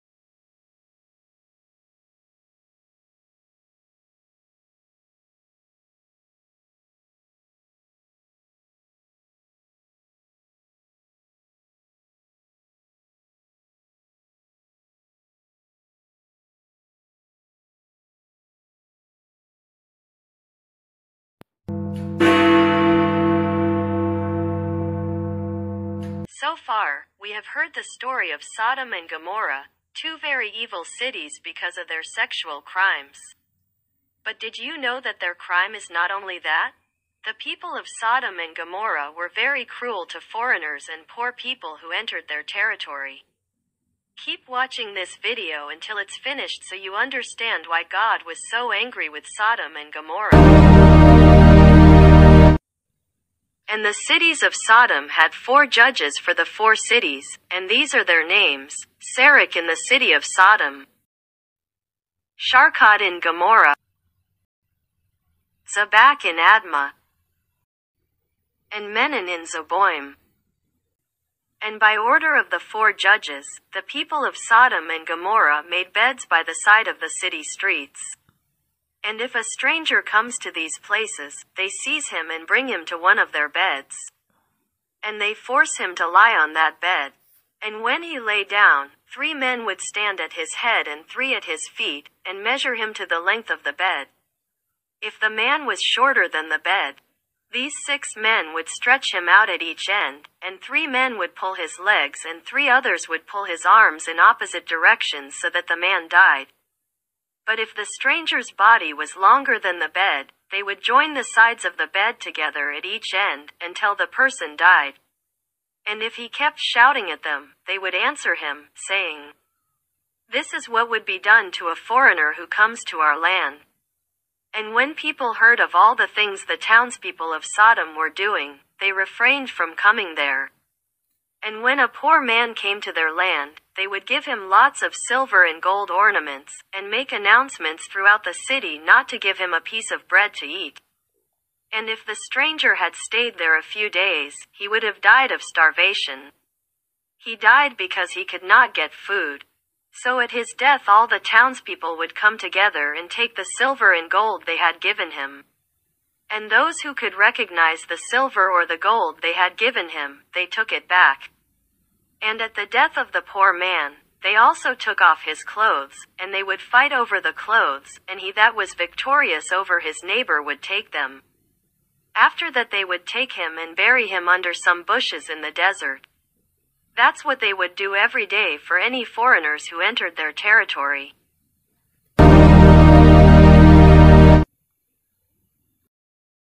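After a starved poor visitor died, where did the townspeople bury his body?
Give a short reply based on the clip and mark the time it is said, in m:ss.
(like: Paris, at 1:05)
Under some bushes in the desert, at 2:54.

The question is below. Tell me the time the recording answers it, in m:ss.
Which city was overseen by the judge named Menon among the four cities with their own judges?
1:09.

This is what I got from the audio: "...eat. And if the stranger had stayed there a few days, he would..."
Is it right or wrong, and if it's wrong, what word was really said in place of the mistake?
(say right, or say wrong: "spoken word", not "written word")
right.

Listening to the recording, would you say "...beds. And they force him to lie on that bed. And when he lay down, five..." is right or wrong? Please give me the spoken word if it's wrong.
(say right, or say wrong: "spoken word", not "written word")
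wrong: "three", not "five".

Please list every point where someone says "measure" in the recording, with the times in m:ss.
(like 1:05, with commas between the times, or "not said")
1:32.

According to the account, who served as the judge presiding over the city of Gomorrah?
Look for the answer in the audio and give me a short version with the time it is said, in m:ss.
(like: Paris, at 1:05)
Sharkot, at 1:02.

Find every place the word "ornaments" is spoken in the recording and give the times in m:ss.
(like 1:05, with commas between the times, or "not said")
2:15.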